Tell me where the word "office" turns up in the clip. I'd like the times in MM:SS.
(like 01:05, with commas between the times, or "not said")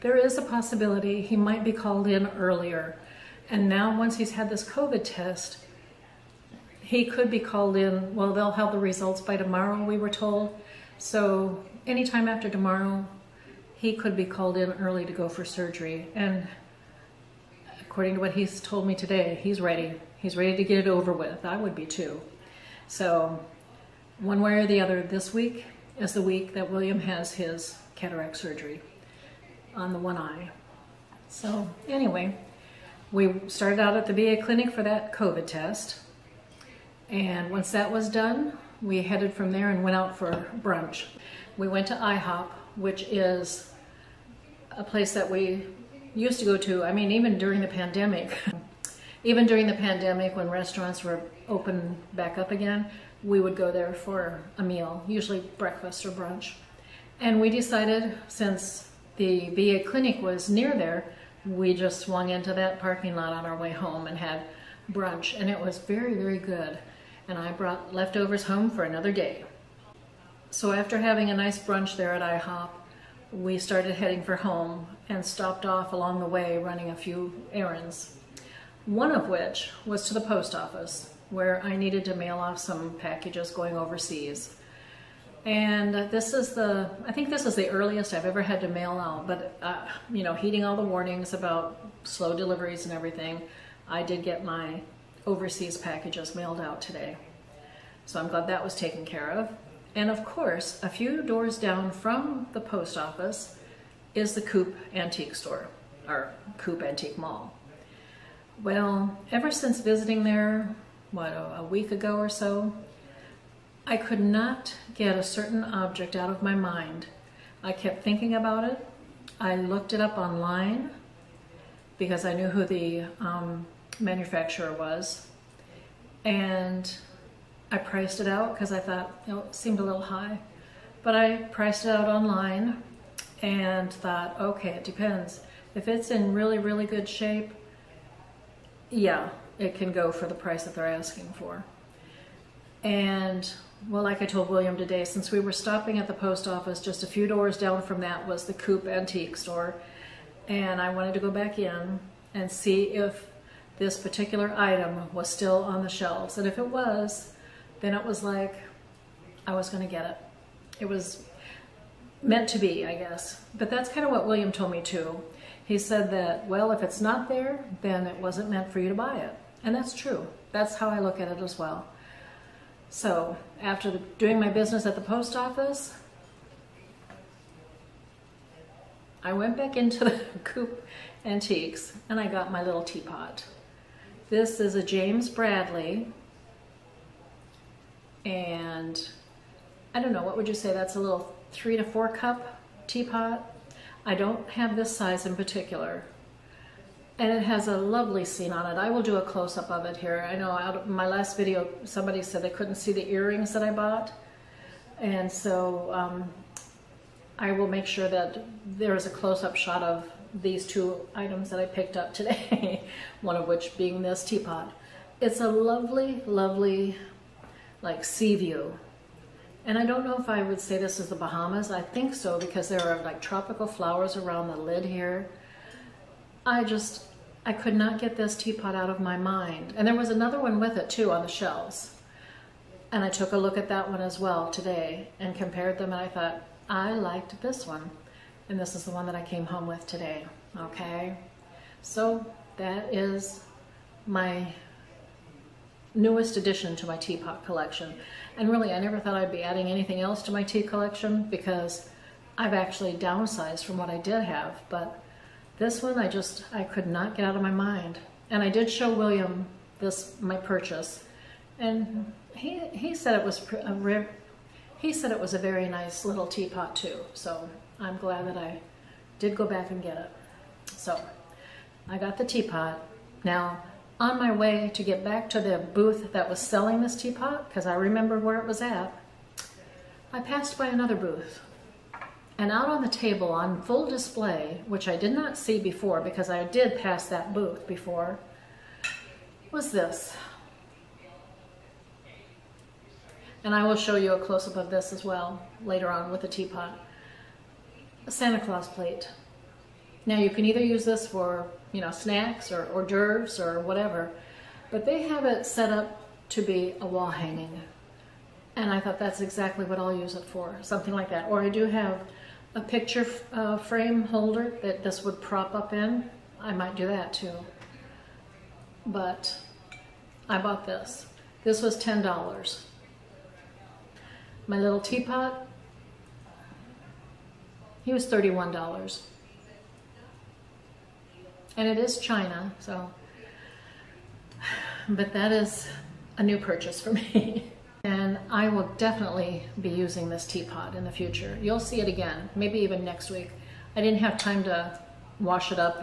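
01:20, 01:42, 02:26, 02:55.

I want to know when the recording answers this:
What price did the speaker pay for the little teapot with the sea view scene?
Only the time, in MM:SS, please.
05:28.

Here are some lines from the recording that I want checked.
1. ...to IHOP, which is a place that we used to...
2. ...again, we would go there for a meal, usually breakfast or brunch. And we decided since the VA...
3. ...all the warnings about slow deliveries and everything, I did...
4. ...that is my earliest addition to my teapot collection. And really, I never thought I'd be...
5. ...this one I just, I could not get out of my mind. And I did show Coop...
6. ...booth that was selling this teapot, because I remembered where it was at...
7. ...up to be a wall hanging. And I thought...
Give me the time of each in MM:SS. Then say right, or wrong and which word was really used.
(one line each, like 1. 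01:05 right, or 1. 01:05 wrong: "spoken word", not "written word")
1. 00:41 right
2. 00:52 right
3. 01:30 right
4. 04:02 wrong: "newest", not "earliest"
5. 04:15 wrong: "William", not "Coop"
6. 04:35 right
7. 05:05 right.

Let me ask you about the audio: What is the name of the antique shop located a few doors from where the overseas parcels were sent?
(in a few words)
Coop Antique Mall.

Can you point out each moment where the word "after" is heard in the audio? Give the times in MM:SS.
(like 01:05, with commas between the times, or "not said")
00:12, 01:10, 02:53.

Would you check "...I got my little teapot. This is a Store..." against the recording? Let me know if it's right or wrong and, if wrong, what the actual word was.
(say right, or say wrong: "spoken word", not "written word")
wrong: "James", not "Store".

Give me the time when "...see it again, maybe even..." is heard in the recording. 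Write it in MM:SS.
05:41.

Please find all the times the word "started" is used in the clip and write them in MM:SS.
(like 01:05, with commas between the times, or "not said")
00:33, 01:13.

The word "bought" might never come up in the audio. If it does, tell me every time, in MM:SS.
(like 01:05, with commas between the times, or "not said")
03:23, 05:20.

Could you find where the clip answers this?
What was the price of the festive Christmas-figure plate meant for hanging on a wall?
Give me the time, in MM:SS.
05:21.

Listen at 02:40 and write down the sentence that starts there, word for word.
It was meant to be, I guess.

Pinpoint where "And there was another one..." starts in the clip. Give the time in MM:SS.
03:49.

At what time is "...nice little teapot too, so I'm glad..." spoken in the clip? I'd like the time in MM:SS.
04:25.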